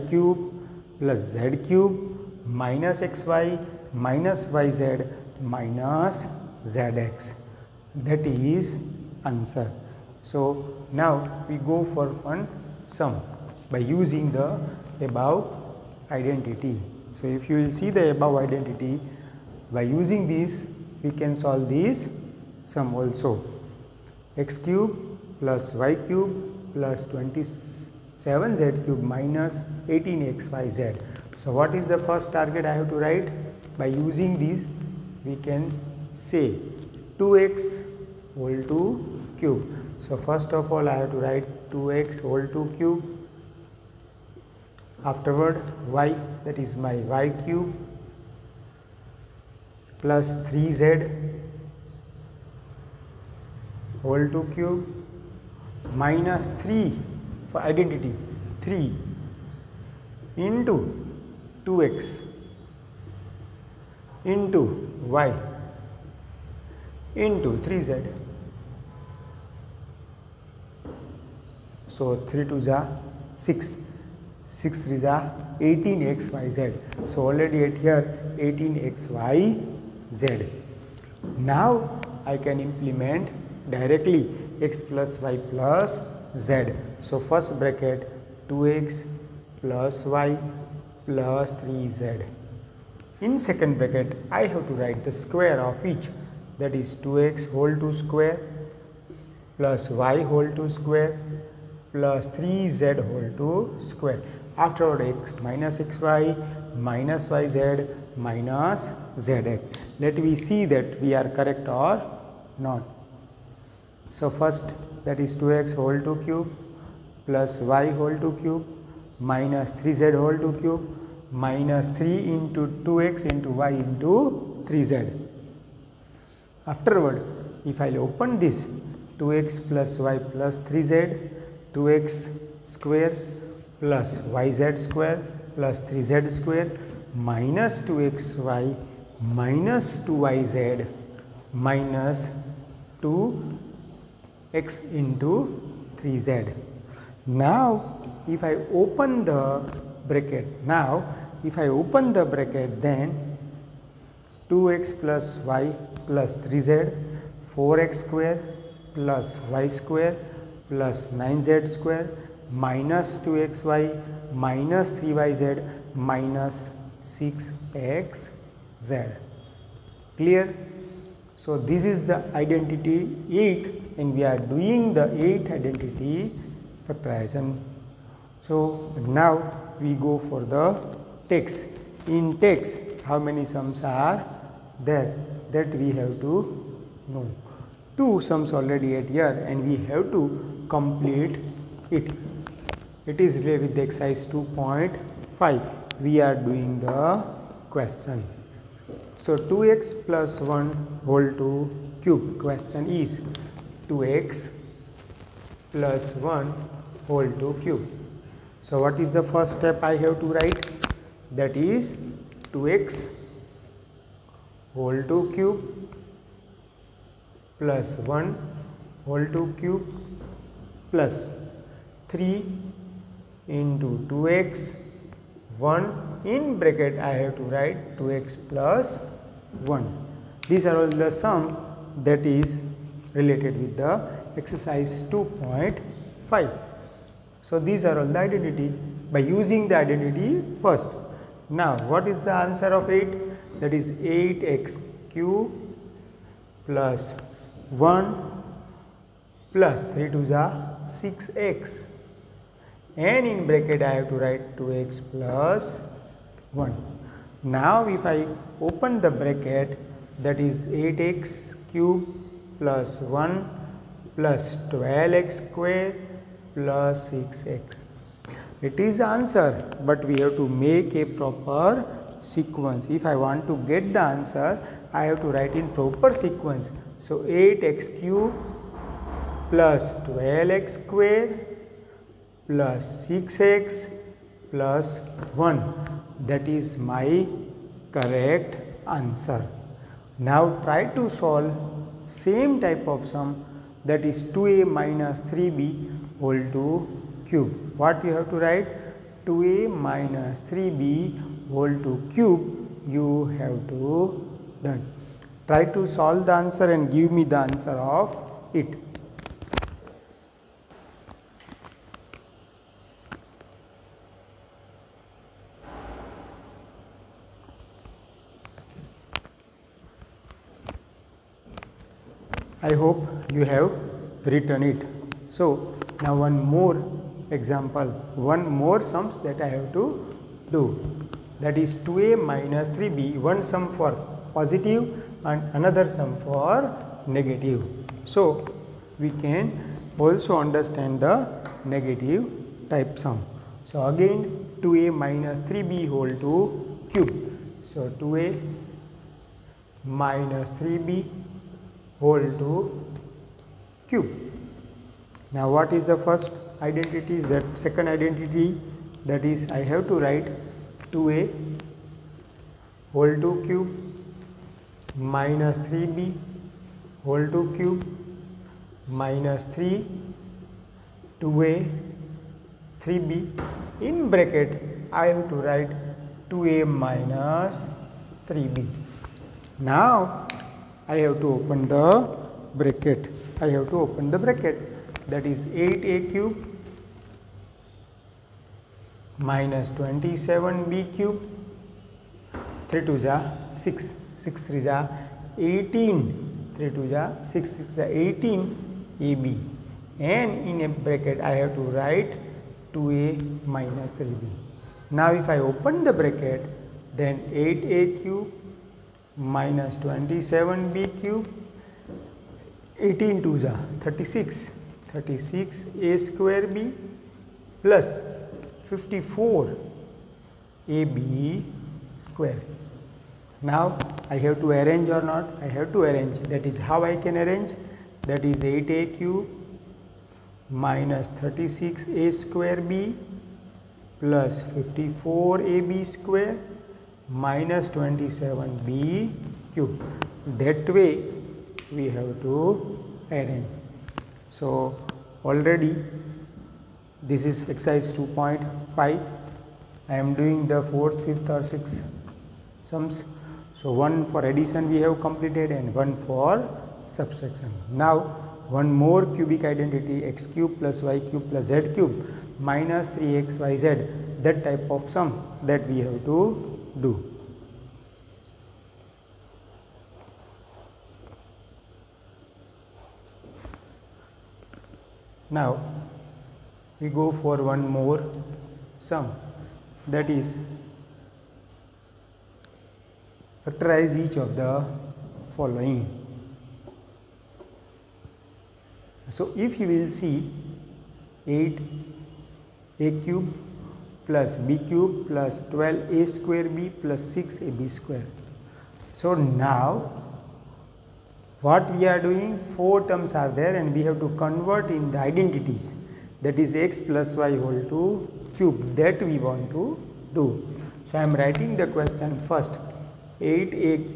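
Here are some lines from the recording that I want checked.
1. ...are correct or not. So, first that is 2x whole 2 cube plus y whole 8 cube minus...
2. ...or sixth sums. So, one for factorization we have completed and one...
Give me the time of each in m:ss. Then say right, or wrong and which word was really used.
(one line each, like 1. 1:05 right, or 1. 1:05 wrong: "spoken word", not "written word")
1. 1:51 wrong: "2", not "8"
2. 7:31 wrong: "addition", not "factorization".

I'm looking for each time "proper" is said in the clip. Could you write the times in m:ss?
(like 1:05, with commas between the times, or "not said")
4:31, 4:35.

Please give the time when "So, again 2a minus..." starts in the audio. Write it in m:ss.
5:43.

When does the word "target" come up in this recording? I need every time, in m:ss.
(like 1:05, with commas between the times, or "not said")
0:32.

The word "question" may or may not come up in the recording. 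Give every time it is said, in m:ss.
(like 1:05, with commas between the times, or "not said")
3:17, 3:22, 8:31.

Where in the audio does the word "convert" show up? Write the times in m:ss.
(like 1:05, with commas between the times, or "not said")
8:24.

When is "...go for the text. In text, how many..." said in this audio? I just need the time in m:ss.
2:59.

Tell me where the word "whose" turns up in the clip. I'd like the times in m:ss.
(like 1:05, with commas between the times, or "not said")
not said.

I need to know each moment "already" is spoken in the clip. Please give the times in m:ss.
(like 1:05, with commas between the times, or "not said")
1:17, 3:08, 7:25.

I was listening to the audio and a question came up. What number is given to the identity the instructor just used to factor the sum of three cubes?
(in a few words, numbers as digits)
8th.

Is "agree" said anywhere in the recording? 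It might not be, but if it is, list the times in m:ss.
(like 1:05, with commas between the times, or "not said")
not said.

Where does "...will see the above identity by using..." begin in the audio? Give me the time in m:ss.
0:17.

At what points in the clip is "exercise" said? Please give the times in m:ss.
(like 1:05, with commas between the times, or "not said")
3:13, 3:54, 7:27.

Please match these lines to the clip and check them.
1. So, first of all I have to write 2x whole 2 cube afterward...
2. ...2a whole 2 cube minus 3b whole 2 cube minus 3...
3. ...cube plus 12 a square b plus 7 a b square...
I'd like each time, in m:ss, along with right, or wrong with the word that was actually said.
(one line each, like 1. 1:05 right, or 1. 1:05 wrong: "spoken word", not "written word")
1. 0:40 right
2. 6:00 right
3. 8:14 wrong: "6", not "7".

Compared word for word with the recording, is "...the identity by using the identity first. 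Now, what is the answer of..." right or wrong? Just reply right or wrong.
right.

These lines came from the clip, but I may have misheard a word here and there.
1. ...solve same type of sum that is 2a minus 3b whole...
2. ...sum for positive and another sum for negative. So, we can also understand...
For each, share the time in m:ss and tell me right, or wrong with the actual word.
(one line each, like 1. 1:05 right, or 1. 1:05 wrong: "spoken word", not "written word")
1. 4:51 right
2. 5:33 right.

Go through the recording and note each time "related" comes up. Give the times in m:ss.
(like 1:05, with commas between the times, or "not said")
3:13, 3:53.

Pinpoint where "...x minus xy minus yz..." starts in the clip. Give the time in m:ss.
1:45.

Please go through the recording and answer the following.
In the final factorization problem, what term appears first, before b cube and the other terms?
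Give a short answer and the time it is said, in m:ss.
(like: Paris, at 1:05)
8a cube, at 8:11.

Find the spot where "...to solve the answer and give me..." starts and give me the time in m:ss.
5:05.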